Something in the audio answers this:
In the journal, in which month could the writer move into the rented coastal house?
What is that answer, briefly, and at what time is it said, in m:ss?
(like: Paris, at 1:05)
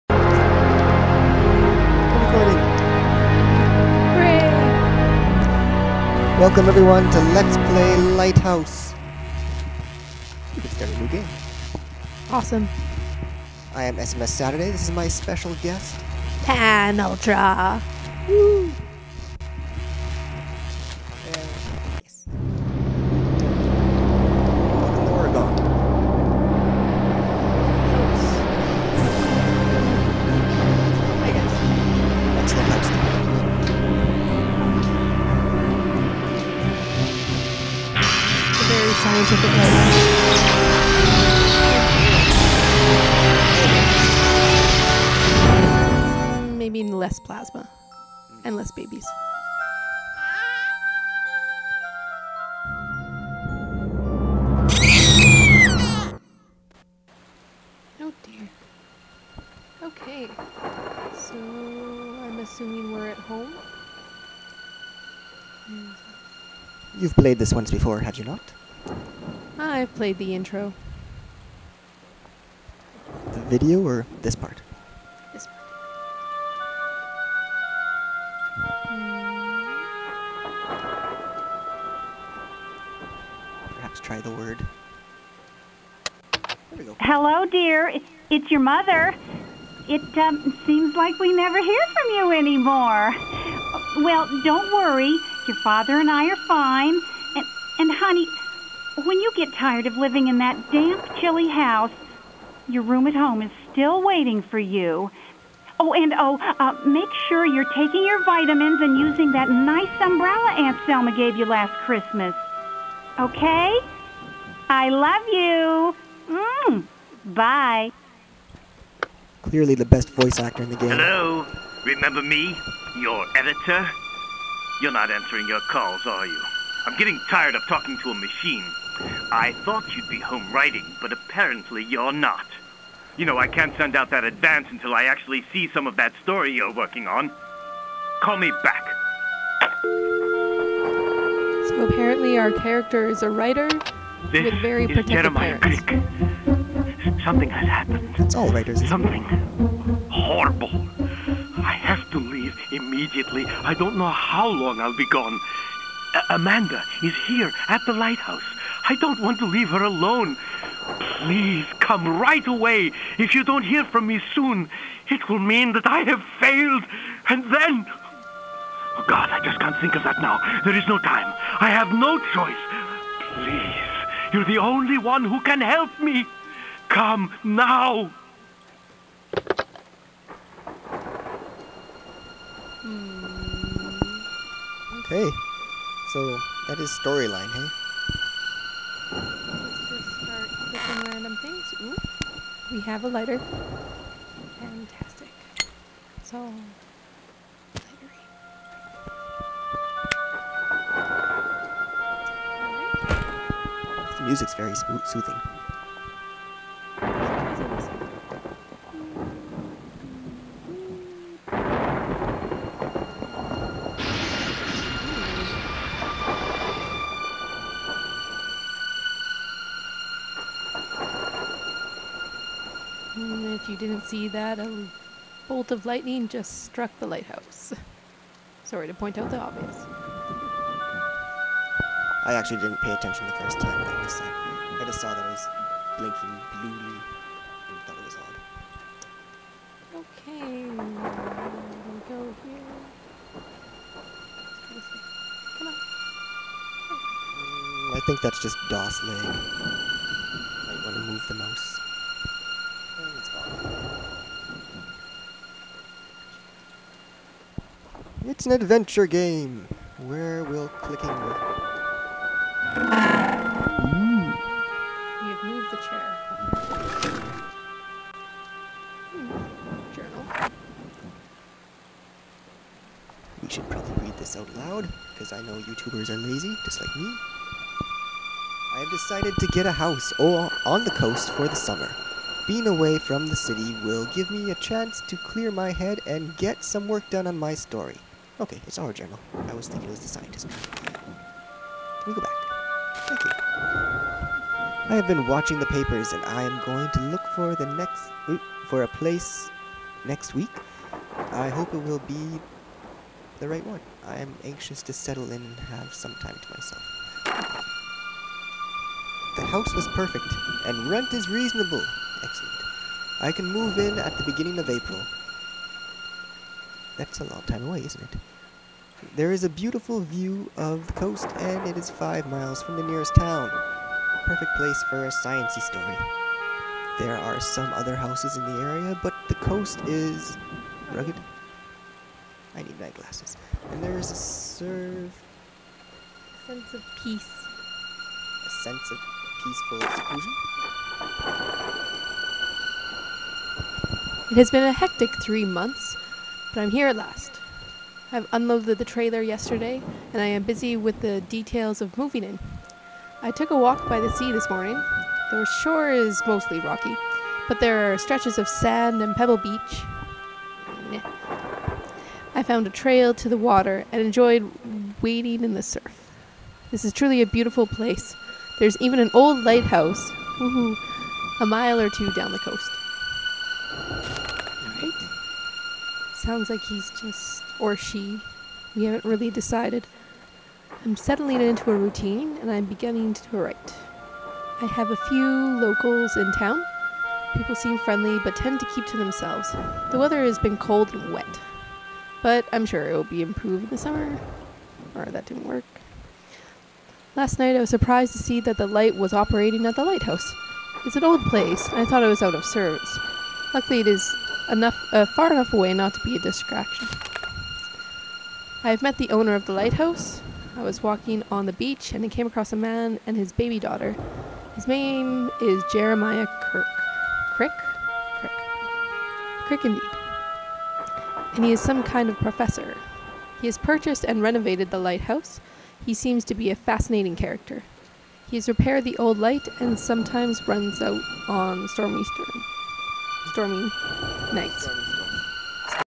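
April, at 5:14.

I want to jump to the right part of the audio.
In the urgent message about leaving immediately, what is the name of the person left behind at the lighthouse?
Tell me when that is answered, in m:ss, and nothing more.
2:36.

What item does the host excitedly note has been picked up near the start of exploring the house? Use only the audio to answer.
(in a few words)
A lighter.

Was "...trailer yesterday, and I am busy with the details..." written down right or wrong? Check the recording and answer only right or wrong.
right.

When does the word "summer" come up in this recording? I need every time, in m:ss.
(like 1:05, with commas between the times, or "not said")
4:41, 6:33.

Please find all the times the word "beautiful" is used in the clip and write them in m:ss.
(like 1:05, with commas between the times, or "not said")
5:19, 6:07.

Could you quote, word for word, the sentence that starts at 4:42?
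Being away from the city will give me a chance to clear my head and get some work done on my story.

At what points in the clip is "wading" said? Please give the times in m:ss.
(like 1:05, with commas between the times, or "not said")
6:05.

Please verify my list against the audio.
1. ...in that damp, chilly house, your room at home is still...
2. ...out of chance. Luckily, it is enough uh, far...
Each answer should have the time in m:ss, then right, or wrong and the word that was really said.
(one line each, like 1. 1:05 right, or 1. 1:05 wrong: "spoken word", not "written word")
1. 1:40 right
2. 6:42 wrong: "service", not "chance".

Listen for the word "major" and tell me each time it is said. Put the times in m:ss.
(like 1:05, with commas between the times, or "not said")
not said.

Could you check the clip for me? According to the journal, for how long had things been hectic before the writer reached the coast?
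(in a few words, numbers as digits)
3 months.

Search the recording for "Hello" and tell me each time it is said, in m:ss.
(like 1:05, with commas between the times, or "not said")
1:26, 2:00.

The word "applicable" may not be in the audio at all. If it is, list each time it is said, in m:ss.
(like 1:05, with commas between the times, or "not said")
not said.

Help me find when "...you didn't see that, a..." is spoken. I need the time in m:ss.
3:43.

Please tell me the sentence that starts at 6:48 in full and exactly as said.
I've met the owner of the lighthouse.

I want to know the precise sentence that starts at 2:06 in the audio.
I'm getting tired of talking to a machine.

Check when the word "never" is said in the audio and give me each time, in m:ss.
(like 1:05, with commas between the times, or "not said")
1:31.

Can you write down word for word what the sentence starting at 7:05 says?
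He seems to be a fascinating character.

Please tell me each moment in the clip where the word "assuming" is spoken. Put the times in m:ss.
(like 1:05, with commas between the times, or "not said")
1:02.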